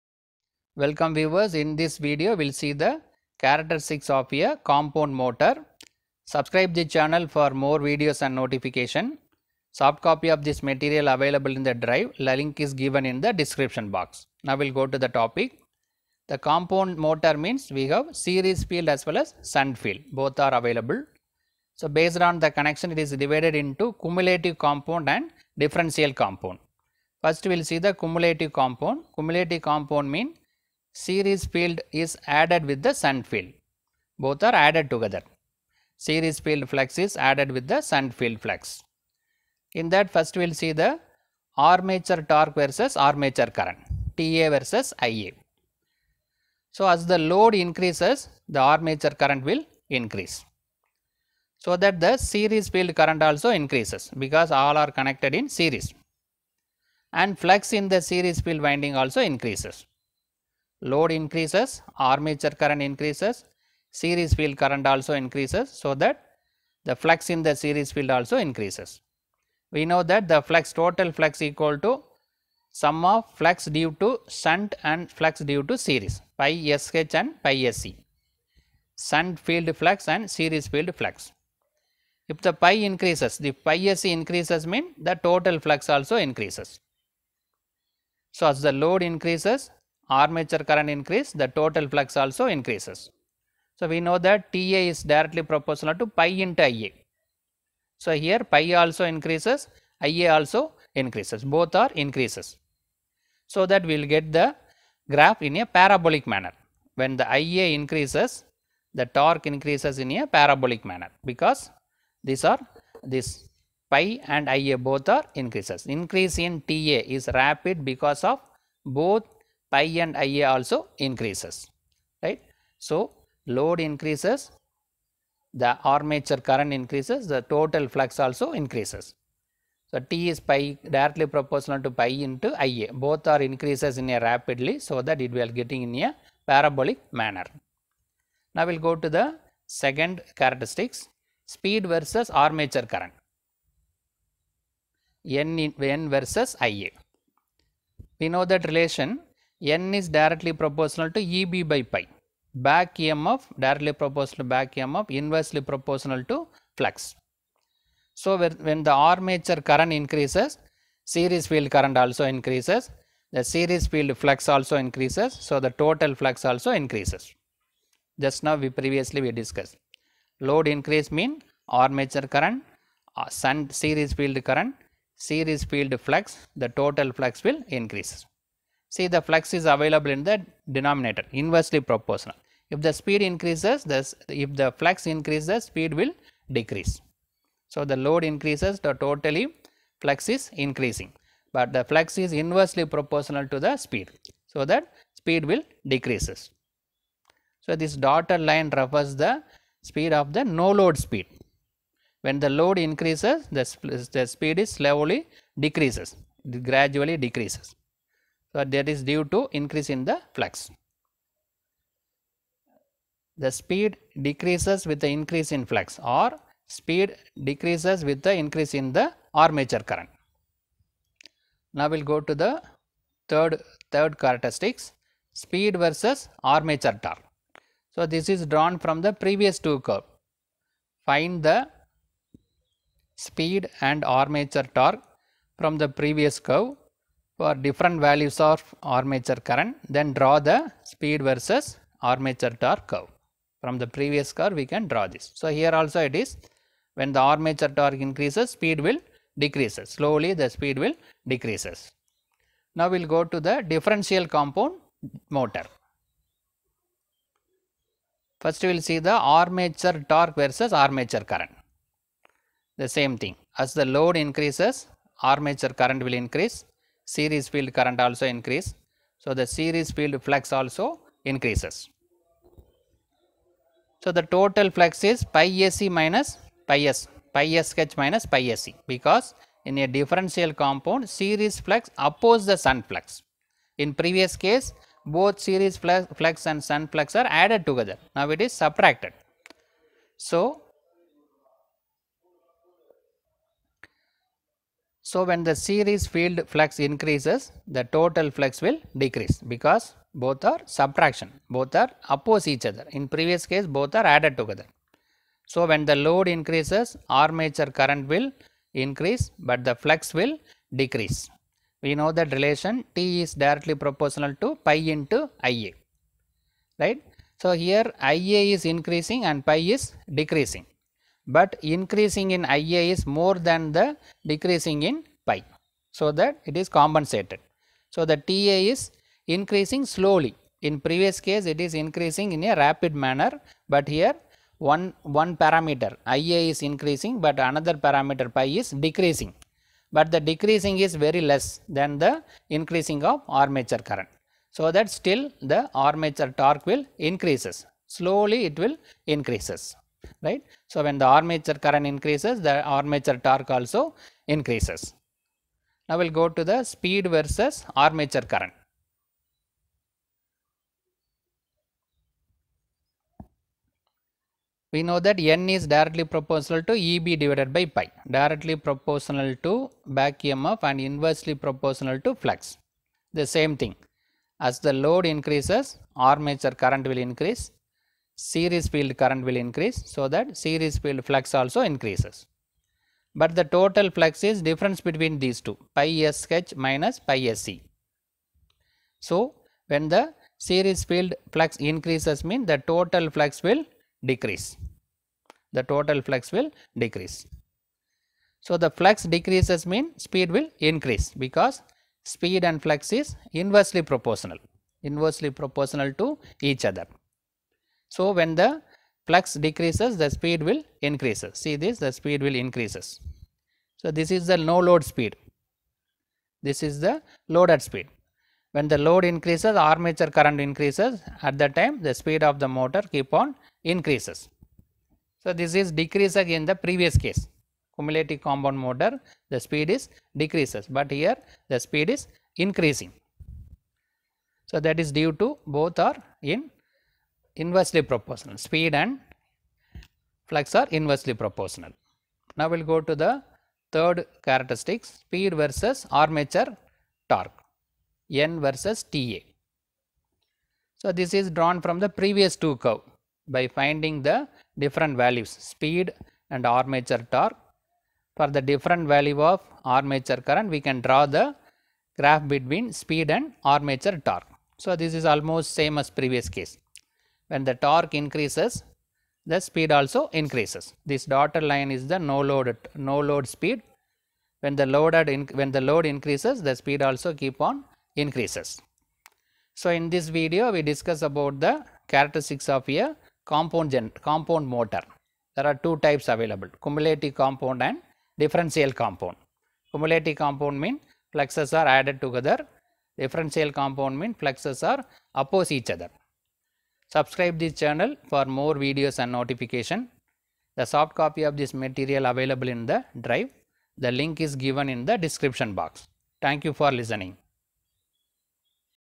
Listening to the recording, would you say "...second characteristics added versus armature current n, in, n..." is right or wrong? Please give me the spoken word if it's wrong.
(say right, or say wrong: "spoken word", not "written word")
wrong: "speed", not "added".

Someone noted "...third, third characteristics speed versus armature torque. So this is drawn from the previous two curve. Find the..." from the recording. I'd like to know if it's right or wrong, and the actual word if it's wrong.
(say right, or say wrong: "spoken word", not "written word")
right.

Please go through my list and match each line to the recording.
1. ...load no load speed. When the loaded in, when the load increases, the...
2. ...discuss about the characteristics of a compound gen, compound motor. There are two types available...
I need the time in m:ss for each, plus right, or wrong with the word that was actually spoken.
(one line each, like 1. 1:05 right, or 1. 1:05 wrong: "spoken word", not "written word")
1. 7:52 right
2. 8:00 right.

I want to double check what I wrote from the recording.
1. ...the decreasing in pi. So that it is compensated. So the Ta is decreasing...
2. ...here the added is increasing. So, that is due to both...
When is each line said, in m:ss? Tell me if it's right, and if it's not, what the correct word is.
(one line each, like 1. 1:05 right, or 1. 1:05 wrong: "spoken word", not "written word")
1. 5:23 wrong: "increasing", not "decreasing"
2. 7:10 wrong: "speed", not "added".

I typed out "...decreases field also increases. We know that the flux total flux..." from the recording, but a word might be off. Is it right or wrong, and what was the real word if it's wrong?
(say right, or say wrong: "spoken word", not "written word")
wrong: "series", not "decreases".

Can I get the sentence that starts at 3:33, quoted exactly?
The speed decreases with the increase in flux or speed decreases with the increase in the armature current.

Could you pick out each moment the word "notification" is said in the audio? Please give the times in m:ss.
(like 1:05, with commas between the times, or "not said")
0:08, 8:19.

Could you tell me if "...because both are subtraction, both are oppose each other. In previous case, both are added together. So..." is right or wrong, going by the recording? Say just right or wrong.
right.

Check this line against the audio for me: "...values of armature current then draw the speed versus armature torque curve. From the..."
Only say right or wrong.
right.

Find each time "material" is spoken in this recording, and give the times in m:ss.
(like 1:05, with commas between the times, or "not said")
0:10, 8:21.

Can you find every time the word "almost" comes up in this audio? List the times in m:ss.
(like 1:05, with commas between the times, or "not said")
7:45.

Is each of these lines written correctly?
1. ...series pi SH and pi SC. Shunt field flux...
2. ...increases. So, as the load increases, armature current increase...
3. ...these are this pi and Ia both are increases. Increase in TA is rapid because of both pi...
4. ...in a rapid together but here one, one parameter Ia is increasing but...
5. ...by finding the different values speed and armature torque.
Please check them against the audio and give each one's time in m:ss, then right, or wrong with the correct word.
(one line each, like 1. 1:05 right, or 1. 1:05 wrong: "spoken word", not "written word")
1. 1:15 right
2. 1:26 right
3. 1:52 right
4. 5:32 wrong: "manner", not "together"
5. 7:33 right.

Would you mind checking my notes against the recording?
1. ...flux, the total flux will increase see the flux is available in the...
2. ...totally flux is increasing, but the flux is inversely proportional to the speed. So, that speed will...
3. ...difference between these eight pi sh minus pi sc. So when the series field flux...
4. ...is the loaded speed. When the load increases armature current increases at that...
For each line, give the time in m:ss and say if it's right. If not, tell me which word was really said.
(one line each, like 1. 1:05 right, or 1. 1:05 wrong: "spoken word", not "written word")
1. 2:56 right
2. 3:08 right
3. 6:24 wrong: "two", not "eight"
4. 6:56 right.